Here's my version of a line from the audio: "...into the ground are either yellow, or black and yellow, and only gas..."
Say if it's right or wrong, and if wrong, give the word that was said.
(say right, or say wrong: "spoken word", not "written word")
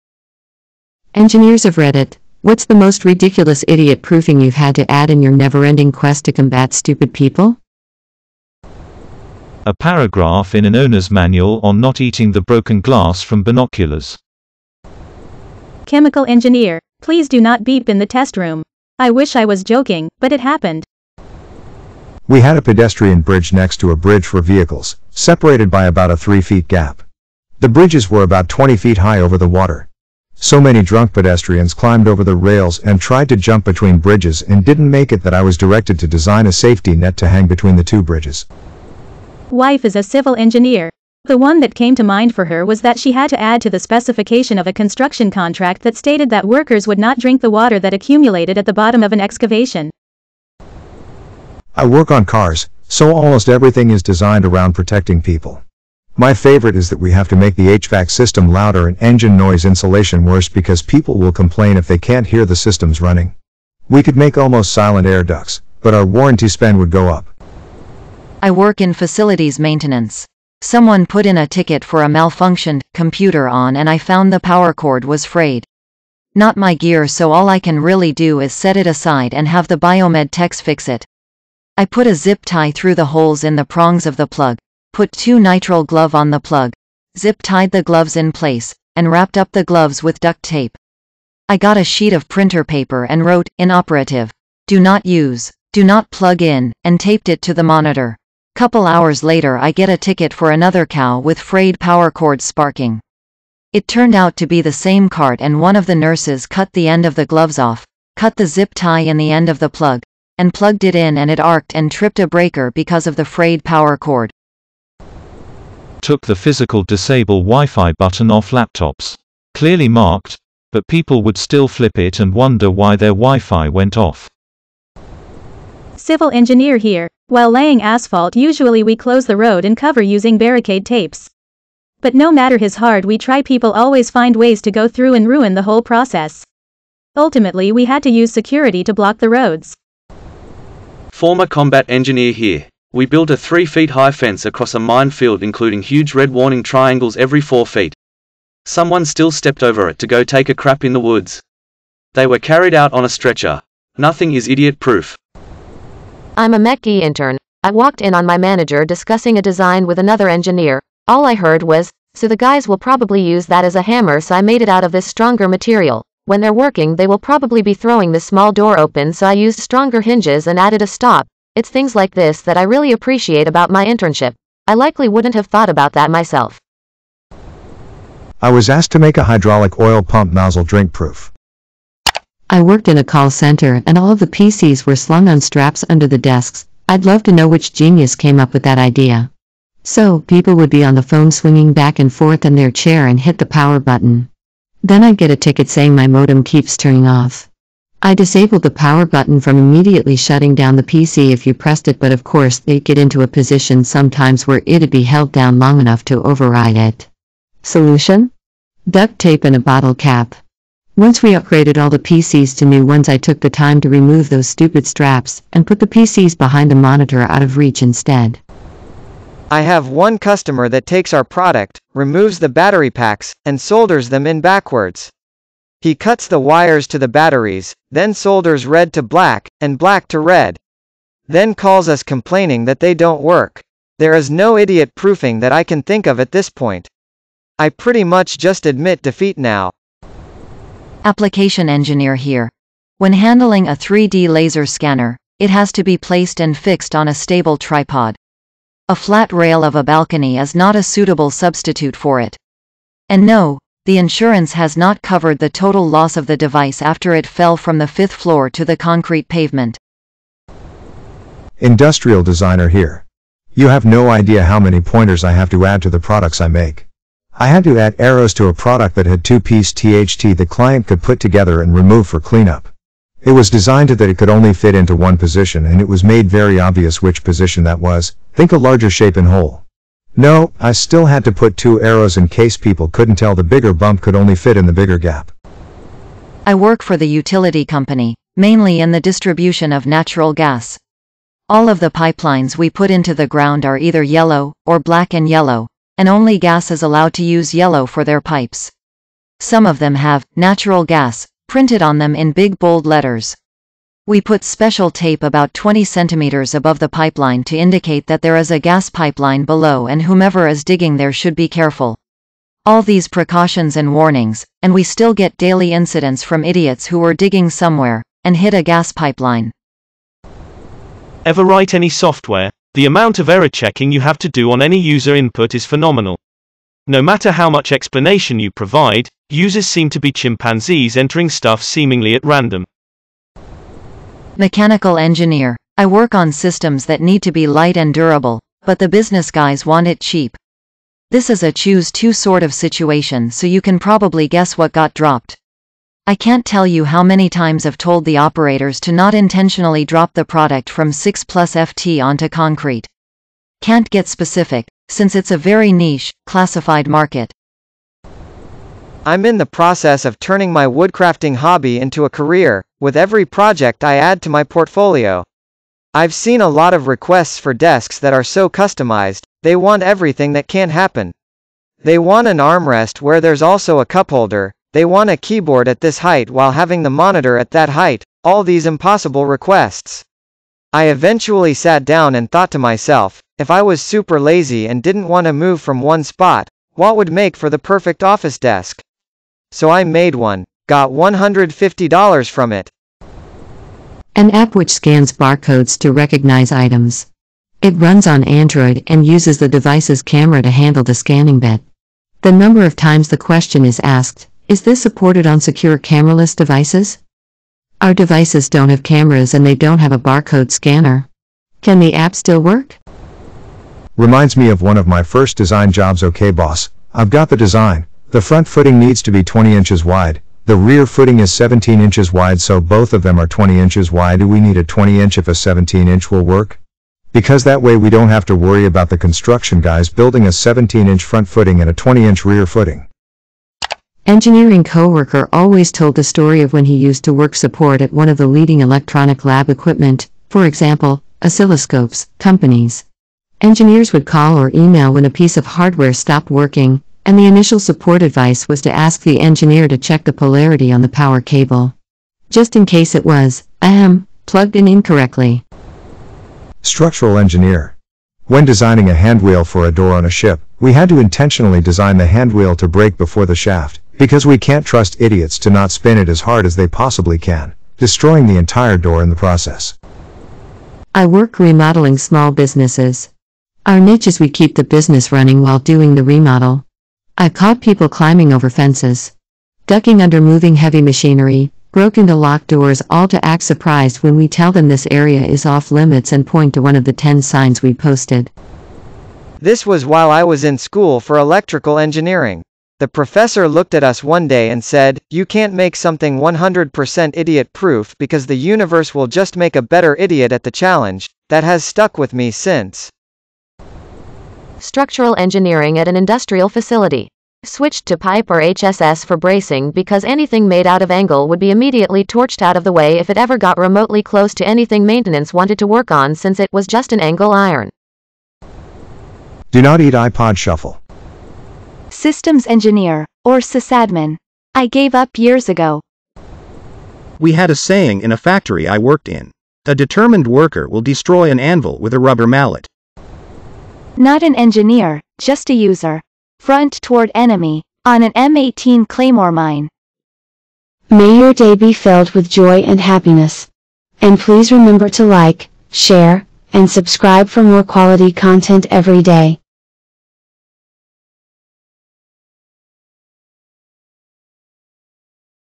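right.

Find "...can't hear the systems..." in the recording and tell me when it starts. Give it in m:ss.
1:01.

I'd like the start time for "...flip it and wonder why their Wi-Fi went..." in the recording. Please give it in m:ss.
2:01.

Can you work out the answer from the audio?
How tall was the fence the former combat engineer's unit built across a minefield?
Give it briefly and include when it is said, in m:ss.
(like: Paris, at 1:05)
3 feet, at 2:23.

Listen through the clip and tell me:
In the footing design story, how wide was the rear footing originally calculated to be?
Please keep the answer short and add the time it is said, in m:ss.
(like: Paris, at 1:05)
17 inches, at 7:01.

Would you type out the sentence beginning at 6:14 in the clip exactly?
they want a keyboard at this height while having the monitor at that height, all these impossible requests.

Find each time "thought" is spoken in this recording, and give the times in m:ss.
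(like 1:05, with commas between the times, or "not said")
2:55, 6:22.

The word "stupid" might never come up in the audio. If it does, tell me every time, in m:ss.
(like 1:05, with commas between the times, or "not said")
0:06, 3:34.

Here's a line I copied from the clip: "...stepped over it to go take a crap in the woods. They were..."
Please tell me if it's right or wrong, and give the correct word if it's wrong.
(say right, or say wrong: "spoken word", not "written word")
right.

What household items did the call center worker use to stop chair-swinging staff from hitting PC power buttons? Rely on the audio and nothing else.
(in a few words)
Duct tape and a bottle cap.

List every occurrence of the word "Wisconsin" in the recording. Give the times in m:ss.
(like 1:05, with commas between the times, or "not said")
not said.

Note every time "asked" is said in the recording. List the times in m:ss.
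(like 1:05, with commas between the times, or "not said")
2:58, 6:43.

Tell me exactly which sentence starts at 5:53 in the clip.
Can't get specific, since it's a very niche, classified market.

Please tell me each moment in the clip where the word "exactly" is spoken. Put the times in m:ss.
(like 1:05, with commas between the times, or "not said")
not said.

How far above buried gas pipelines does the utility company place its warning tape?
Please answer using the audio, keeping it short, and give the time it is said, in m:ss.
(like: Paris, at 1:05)
20 centimeters, at 5:05.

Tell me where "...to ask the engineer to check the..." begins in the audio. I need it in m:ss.
7:28.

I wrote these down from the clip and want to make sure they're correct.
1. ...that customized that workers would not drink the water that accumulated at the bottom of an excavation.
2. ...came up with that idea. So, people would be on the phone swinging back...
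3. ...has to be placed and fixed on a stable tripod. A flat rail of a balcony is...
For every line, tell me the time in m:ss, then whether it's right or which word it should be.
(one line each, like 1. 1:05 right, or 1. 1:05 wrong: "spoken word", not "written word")
1. 0:45 wrong: "stated", not "customized"
2. 3:08 right
3. 4:05 right.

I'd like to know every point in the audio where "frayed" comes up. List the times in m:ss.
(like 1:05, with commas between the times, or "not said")
1:15, 1:41, 1:53.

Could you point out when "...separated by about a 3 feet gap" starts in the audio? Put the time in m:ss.
0:25.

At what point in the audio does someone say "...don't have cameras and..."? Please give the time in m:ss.
6:48.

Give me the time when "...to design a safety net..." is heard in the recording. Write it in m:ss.
0:35.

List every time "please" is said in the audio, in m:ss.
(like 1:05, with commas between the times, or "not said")
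0:17, 9:04.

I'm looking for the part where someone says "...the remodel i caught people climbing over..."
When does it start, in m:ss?
7:55.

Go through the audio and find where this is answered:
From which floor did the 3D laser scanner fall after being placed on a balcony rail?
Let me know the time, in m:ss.
4:17.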